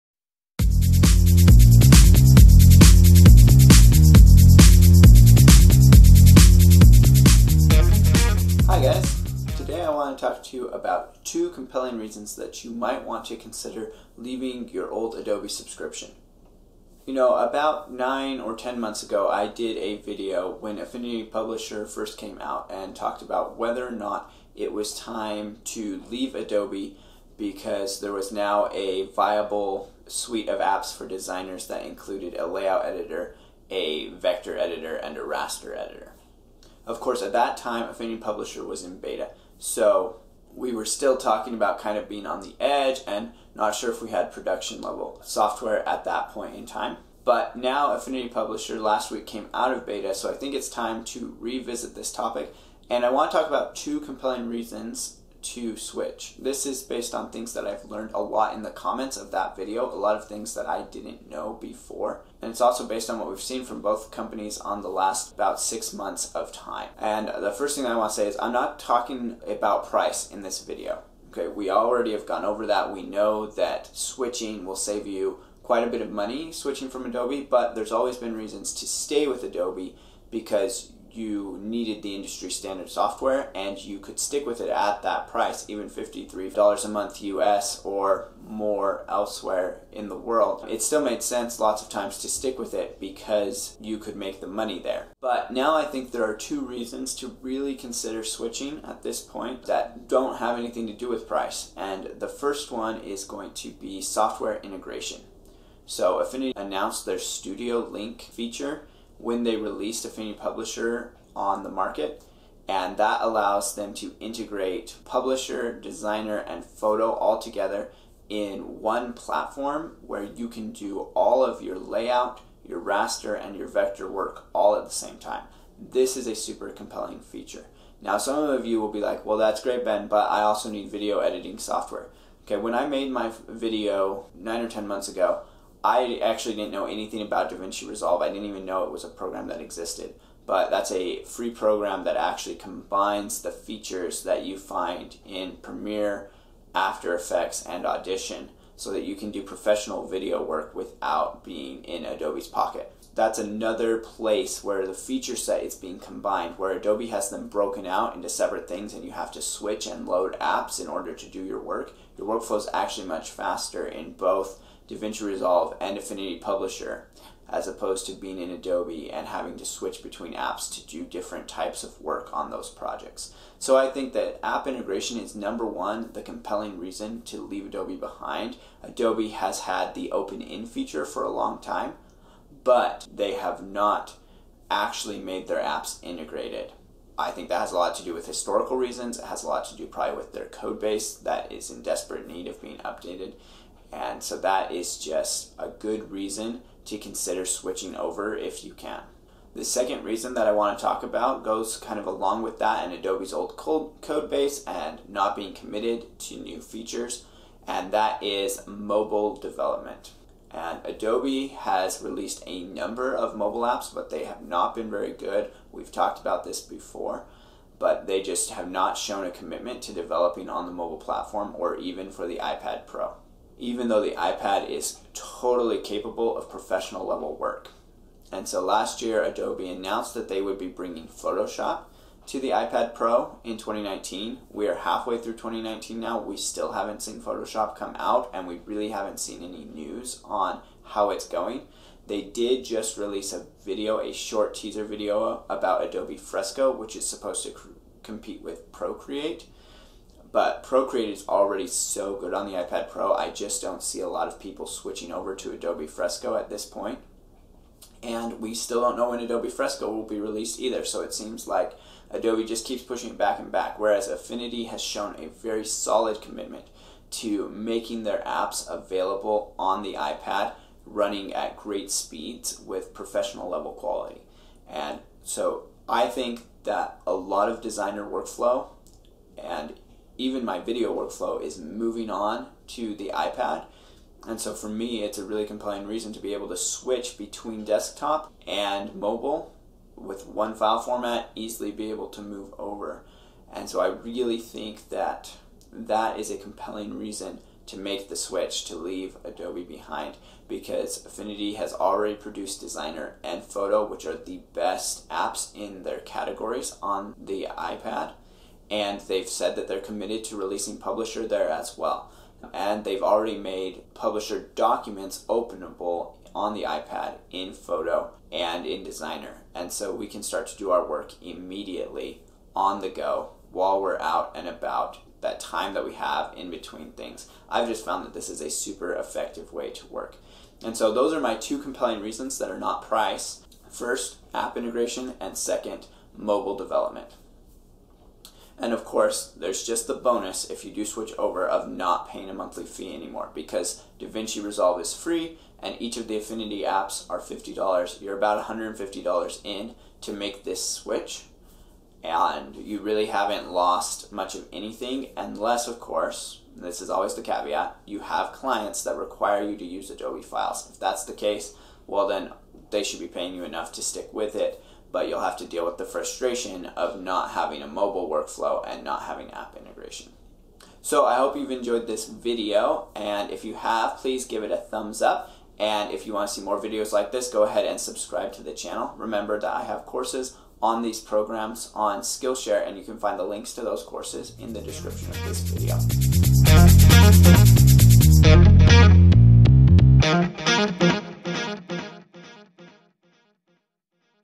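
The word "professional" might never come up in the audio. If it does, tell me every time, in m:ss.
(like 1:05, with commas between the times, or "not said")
2:29, 3:46, 4:32.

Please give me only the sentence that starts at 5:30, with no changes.
And so those are my two compelling reasons that are not price.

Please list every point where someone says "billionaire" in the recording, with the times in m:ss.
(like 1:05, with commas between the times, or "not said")
not said.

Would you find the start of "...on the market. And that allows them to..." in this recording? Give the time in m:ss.
1:51.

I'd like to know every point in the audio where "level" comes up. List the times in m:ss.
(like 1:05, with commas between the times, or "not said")
0:44, 3:47, 4:33.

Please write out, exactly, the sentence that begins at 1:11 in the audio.
Okay, we already have gone over that.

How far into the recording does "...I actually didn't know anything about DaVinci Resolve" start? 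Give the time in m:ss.
2:15.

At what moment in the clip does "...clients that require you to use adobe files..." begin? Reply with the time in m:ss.
5:58.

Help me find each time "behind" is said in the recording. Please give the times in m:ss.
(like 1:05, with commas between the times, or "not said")
2:57, 4:59.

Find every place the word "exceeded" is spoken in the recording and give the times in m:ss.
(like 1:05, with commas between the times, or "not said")
not said.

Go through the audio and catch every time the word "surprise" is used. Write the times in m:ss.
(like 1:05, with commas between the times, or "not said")
not said.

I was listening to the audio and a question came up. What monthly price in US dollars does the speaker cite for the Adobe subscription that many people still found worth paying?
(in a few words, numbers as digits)
$53.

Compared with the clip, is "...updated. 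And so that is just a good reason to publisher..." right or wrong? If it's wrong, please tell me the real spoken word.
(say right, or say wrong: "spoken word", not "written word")
wrong: "consider", not "publisher".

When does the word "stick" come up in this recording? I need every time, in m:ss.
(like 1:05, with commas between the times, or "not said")
1:24, 1:32, 6:03.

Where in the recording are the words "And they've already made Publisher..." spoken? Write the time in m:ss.
5:12.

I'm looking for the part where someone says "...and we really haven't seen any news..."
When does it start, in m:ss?
3:58.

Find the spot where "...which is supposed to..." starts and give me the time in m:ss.
4:06.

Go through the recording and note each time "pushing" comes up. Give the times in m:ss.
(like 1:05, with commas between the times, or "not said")
4:22.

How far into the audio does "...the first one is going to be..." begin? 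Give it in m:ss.
1:42.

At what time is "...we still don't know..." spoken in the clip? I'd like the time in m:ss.
4:18.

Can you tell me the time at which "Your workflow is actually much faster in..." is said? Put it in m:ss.
2:42.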